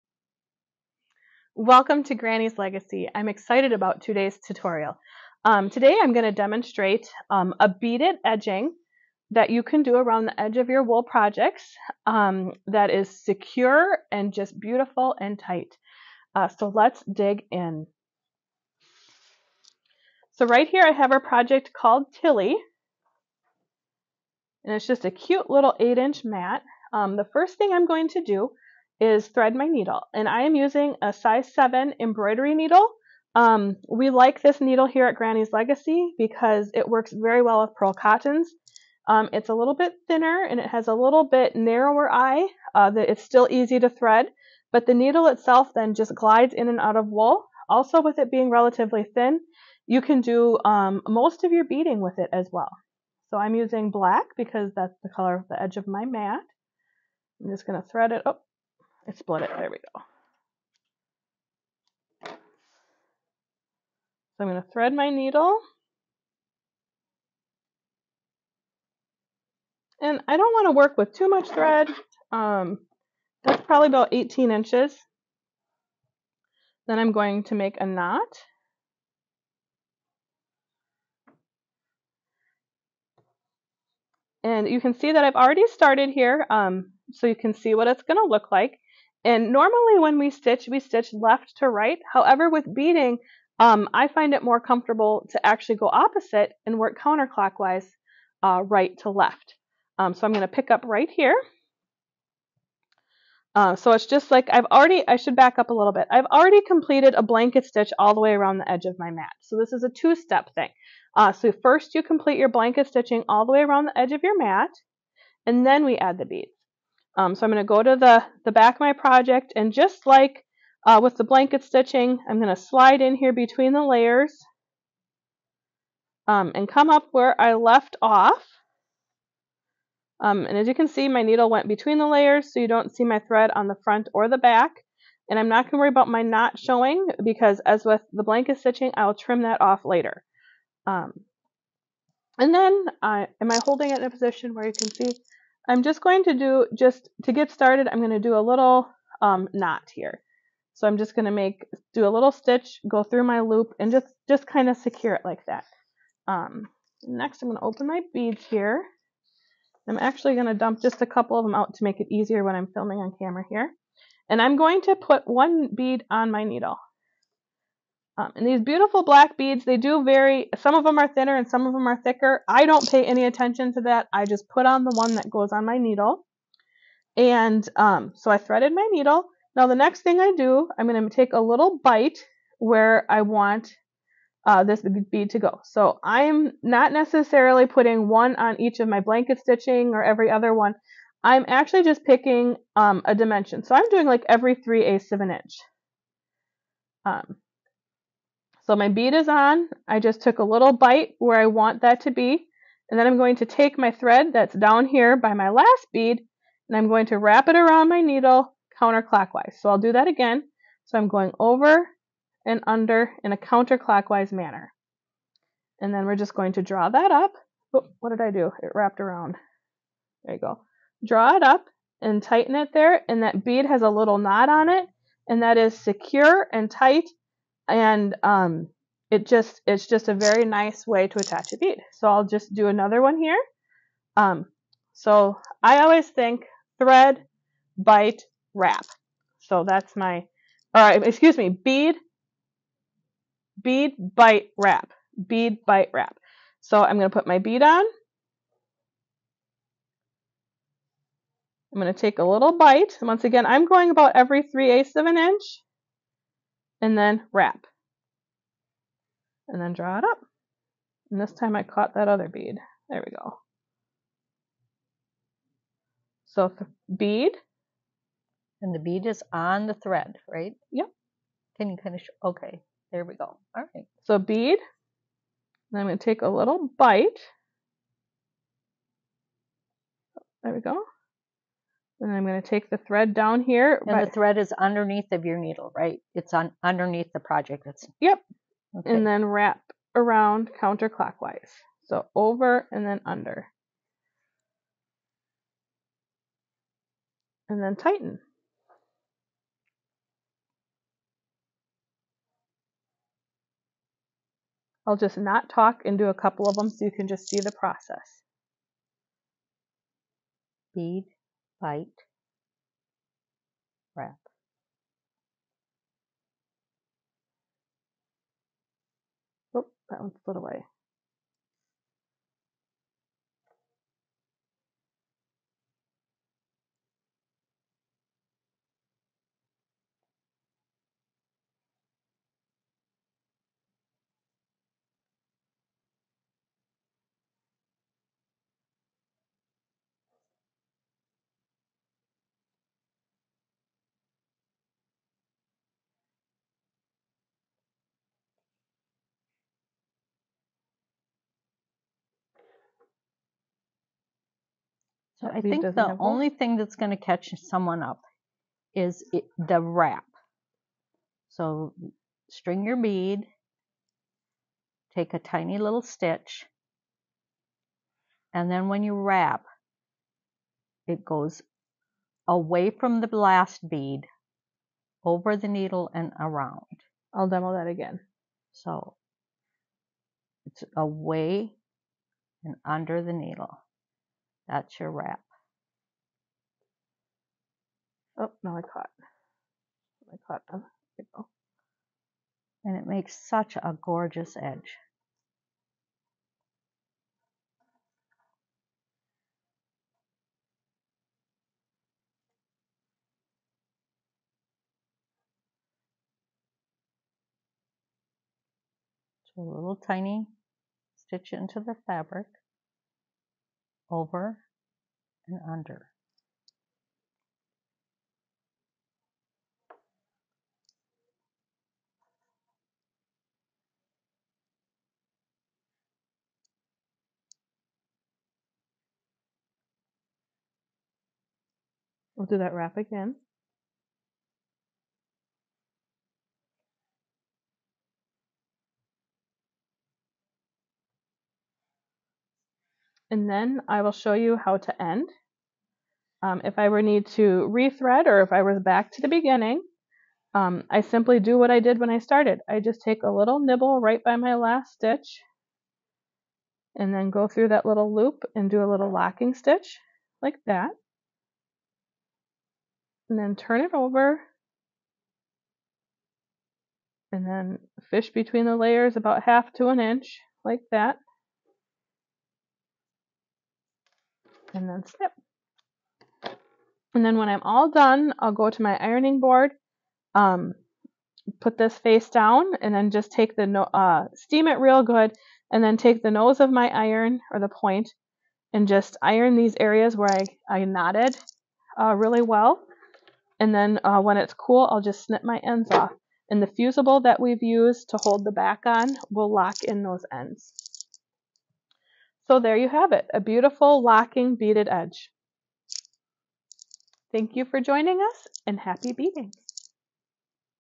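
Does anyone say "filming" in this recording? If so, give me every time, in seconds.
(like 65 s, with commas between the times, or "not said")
162 s.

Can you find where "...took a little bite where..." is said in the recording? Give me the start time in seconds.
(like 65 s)
200 s.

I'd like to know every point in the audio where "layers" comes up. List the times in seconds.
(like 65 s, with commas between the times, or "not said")
123 s, 132 s, 468 s.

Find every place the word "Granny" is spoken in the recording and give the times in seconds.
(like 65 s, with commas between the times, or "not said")
2 s, 35 s.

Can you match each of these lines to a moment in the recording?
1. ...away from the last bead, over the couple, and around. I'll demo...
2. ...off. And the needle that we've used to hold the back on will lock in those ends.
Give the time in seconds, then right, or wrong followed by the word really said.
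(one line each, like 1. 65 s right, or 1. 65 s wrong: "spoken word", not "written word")
1. 372 s wrong: "needle", not "couple"
2. 495 s wrong: "fusible", not "needle".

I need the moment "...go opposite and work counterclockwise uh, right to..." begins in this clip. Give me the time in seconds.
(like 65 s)
95 s.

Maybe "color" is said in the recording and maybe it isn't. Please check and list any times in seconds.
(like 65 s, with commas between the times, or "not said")
55 s.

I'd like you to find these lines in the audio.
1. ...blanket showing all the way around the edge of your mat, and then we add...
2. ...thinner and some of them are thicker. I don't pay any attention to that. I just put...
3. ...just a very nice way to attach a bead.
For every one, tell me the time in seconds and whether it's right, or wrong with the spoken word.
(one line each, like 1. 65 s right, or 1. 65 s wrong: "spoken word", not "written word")
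1. 112 s wrong: "stitching", not "showing"
2. 171 s right
3. 229 s right.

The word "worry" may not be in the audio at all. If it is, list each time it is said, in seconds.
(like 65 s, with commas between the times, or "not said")
135 s.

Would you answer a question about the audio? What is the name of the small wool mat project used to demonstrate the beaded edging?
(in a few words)
Tilly.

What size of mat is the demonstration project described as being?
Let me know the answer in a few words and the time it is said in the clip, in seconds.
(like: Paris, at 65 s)
8 inch, at 25 s.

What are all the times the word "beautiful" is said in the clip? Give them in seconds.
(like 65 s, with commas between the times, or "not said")
14 s, 168 s, 503 s.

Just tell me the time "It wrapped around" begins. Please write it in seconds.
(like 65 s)
218 s.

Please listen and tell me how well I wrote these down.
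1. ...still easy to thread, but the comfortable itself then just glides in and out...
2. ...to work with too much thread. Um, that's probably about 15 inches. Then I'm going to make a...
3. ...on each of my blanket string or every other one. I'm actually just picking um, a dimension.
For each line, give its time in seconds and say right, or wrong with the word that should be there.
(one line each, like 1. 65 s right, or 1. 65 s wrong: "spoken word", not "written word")
1. 43 s wrong: "needle", not "comfortable"
2. 70 s wrong: "18", not "15"
3. 188 s wrong: "stitching", not "string".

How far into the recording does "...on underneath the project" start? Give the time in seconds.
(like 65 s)
286 s.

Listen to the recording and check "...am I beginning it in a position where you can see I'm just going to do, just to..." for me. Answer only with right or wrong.
wrong.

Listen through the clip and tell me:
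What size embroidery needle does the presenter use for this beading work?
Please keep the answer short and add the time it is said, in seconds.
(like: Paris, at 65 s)
7, at 31 s.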